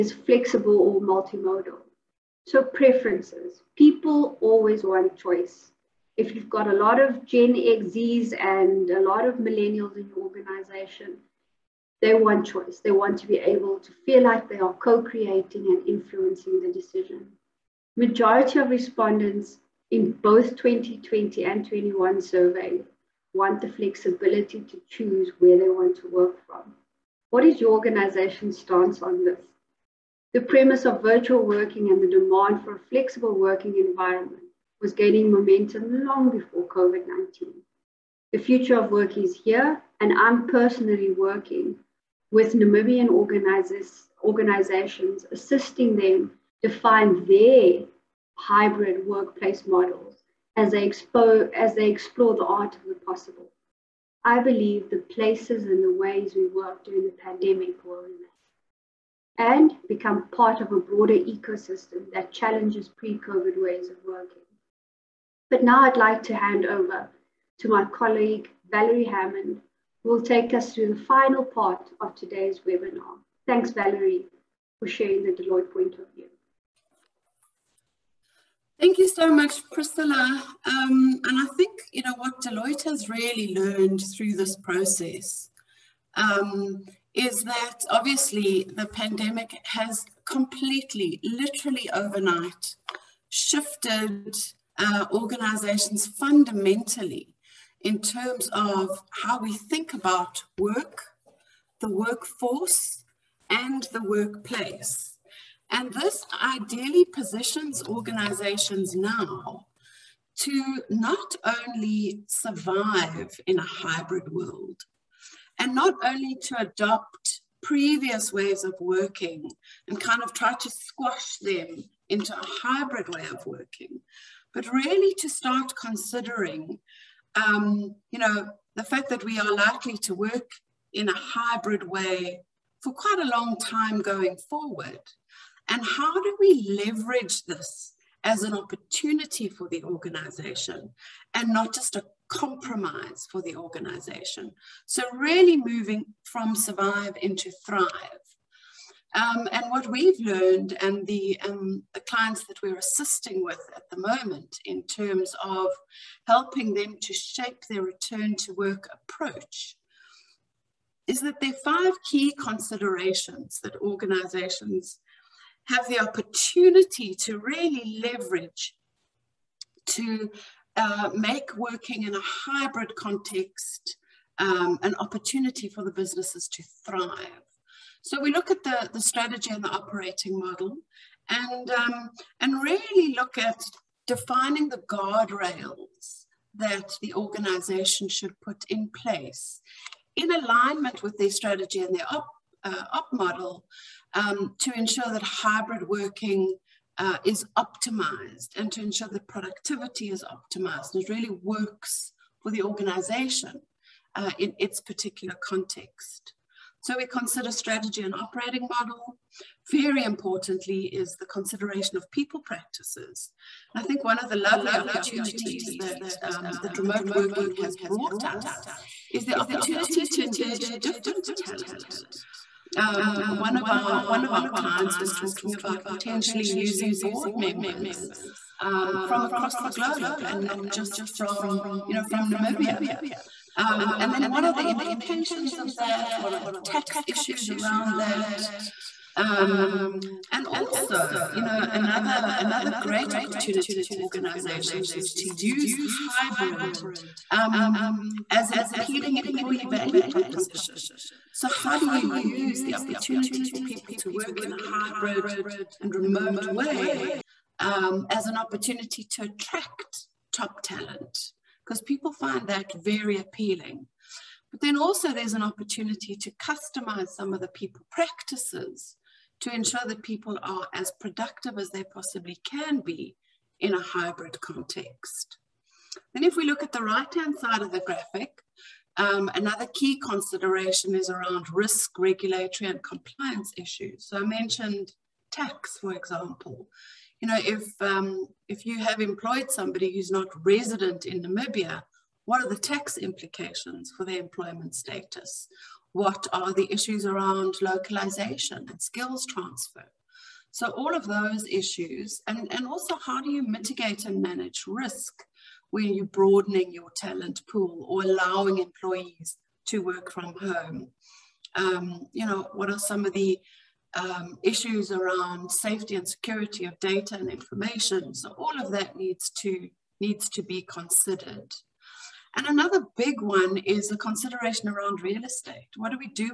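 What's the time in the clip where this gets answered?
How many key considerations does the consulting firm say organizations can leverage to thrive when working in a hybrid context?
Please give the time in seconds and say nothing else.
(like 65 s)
161 s.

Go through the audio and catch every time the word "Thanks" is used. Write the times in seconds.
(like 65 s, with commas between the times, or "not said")
73 s, 78 s.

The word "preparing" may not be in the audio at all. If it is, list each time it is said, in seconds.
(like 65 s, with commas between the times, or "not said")
not said.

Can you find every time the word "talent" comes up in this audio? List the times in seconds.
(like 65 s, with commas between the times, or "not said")
221 s, 260 s, 306 s.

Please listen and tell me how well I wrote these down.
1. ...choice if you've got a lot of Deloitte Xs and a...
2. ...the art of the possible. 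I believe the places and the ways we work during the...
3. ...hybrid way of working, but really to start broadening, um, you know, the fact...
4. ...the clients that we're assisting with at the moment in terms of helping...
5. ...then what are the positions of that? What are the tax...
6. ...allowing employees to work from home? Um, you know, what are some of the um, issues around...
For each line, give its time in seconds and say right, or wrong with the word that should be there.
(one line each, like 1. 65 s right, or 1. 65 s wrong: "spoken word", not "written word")
1. 5 s wrong: "Gen", not "Deloitte"
2. 52 s right
3. 122 s wrong: "considering", not "broadening"
4. 151 s right
5. 234 s wrong: "implications", not "positions"
6. 308 s right.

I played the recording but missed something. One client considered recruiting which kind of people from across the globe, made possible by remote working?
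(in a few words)
Board members.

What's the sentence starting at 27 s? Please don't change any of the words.
What is your organization's stance on this?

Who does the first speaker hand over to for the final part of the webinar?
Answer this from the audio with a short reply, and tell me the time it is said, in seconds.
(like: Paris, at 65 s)
Valerie Hammond, at 68 s.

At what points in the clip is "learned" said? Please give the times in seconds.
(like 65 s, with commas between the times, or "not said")
83 s, 150 s.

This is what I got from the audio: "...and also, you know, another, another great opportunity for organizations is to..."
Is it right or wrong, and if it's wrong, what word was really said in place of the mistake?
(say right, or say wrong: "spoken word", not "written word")
right.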